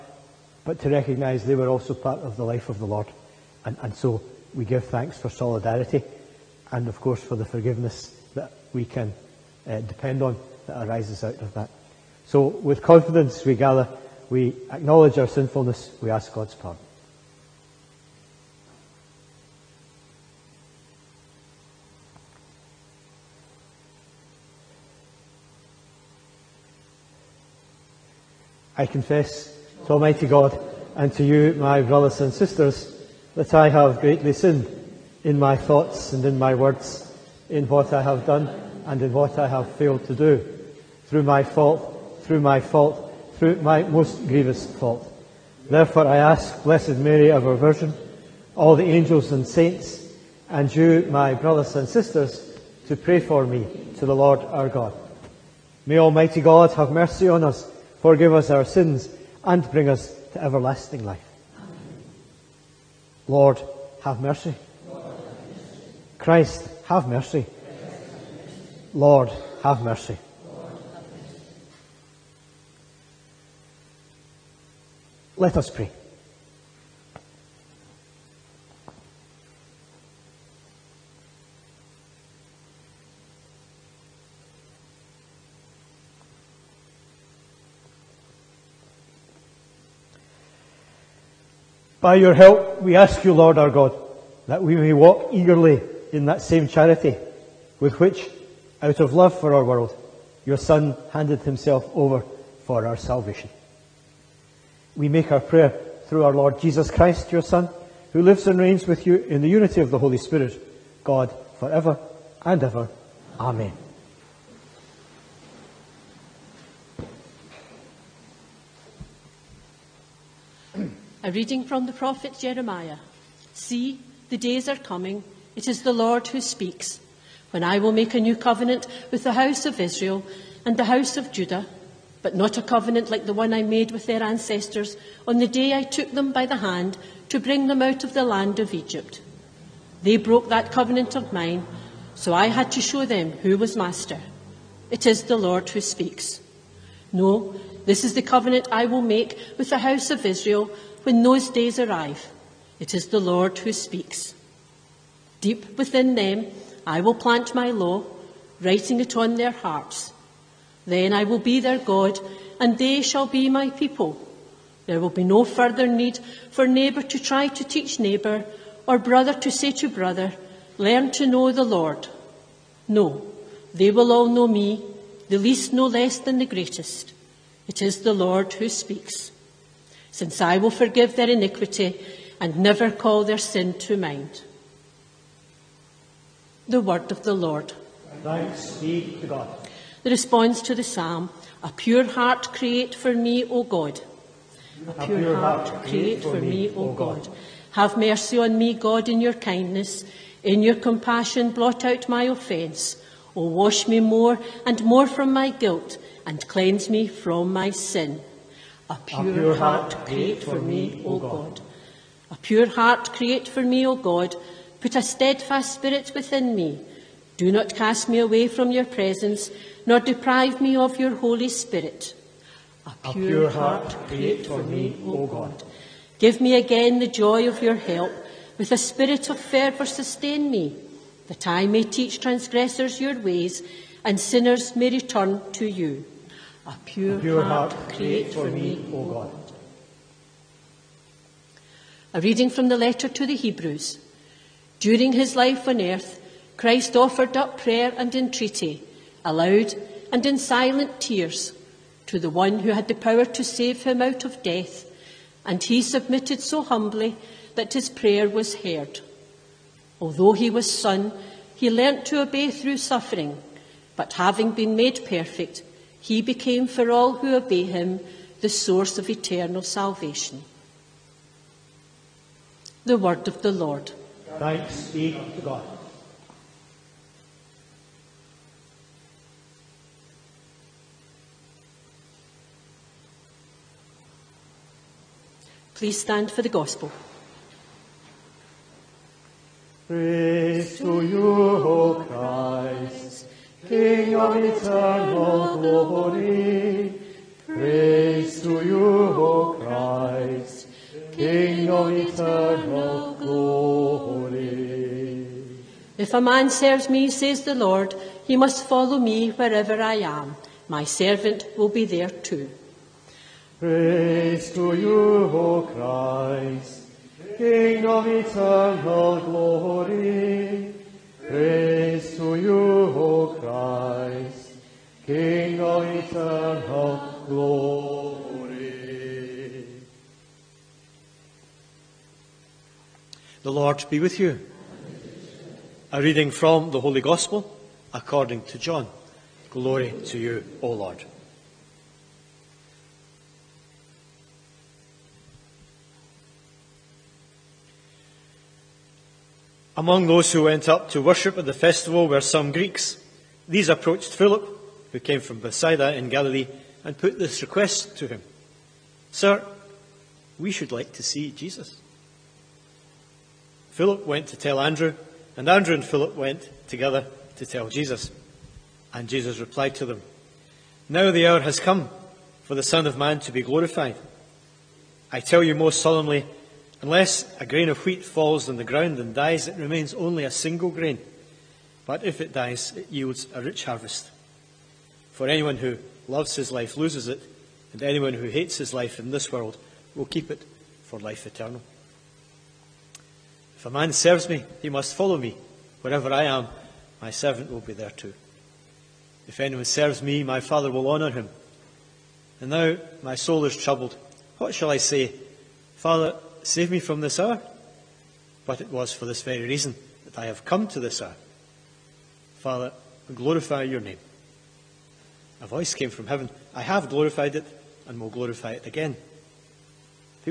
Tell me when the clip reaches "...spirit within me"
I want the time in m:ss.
3:35.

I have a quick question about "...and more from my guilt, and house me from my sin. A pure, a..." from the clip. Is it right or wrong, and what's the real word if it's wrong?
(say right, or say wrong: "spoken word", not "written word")
wrong: "cleanse", not "house".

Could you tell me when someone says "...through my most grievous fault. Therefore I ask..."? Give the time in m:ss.
0:43.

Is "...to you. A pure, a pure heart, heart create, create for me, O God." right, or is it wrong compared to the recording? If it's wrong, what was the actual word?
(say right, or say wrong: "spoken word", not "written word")
right.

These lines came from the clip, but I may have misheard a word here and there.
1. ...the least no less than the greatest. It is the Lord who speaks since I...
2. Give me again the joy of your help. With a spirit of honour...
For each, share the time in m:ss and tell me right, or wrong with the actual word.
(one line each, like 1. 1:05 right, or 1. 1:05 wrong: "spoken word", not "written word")
1. 2:55 right
2. 3:46 wrong: "fervour", not "honour".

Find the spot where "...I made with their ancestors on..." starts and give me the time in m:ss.
2:13.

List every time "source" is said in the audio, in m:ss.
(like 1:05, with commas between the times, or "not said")
4:28.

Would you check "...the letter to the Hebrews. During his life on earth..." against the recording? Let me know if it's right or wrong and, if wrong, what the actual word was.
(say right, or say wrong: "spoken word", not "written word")
right.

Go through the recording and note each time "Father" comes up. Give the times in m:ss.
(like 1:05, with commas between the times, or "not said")
6:40, 6:45, 6:52.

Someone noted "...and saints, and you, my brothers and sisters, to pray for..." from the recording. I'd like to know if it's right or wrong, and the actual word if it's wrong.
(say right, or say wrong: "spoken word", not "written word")
right.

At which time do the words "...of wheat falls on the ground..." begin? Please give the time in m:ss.
6:17.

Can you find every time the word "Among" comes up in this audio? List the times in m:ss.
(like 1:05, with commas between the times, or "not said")
5:49.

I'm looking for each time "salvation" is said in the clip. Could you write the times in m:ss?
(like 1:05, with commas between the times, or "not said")
1:42, 4:29.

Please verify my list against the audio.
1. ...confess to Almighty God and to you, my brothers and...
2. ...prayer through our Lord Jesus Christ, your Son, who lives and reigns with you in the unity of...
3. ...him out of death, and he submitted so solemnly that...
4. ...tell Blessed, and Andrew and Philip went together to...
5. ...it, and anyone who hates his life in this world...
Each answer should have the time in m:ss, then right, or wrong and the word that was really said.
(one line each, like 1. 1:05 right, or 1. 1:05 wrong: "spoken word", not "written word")
1. 0:28 right
2. 1:45 right
3. 4:13 wrong: "humbly", not "solemnly"
4. 6:04 wrong: "Andrew", not "Blessed"
5. 6:27 right.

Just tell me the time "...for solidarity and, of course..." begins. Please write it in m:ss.
0:05.